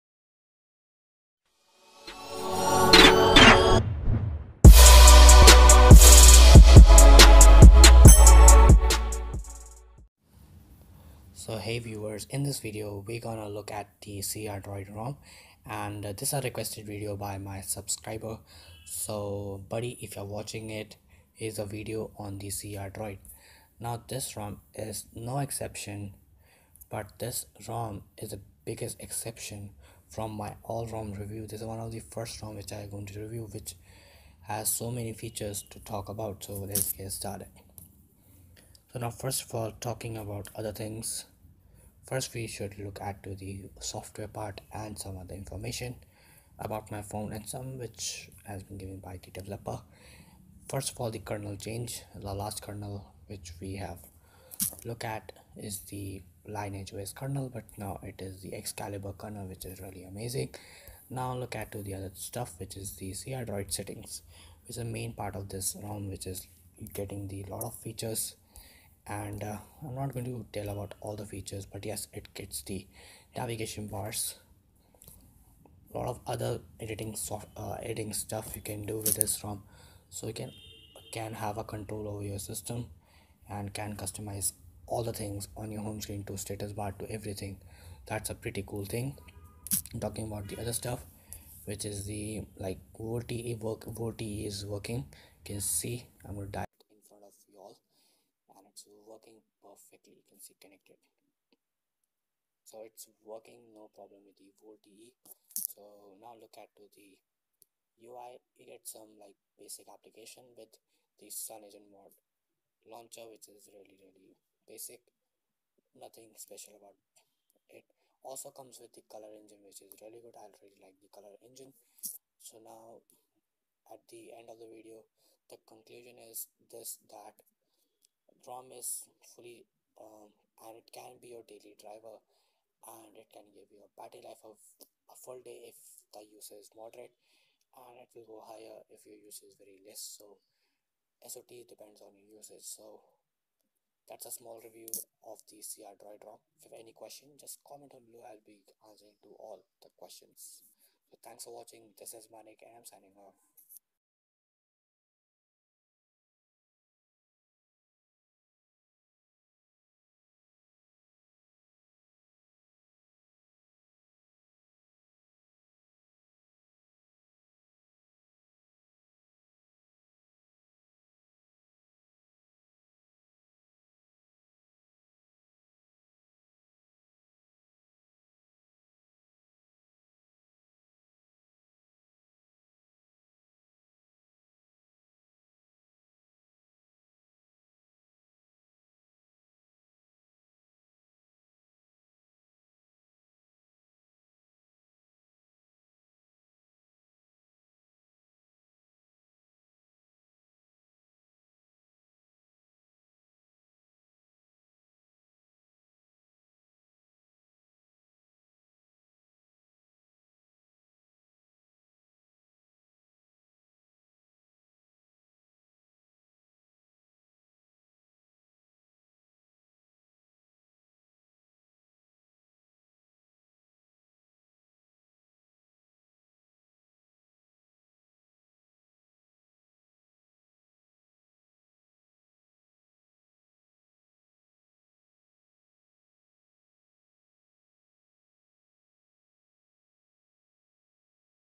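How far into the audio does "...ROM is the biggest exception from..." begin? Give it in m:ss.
0:27.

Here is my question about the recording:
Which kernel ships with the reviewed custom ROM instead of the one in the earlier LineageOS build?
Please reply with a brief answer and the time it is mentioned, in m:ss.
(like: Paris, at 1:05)
Excalibur kernel, at 0:58.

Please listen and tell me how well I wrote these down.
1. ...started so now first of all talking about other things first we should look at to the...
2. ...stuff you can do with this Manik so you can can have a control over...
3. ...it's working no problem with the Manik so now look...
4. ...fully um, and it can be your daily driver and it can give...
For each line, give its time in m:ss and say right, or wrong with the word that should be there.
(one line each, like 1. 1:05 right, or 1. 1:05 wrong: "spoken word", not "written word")
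1. 0:37 right
2. 1:18 wrong: "ROM", not "Manik"
3. 1:42 wrong: "VoLTE", not "Manik"
4. 2:09 right.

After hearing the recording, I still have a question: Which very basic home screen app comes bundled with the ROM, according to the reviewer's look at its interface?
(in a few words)
Sun Agent mod launcher.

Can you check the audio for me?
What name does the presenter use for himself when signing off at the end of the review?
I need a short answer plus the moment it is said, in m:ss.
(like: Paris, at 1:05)
Manik, at 2:32.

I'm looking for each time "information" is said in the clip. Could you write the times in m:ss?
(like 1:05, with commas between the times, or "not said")
0:45.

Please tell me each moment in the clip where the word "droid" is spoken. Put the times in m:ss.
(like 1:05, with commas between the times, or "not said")
0:14, 0:22, 1:03, 2:25.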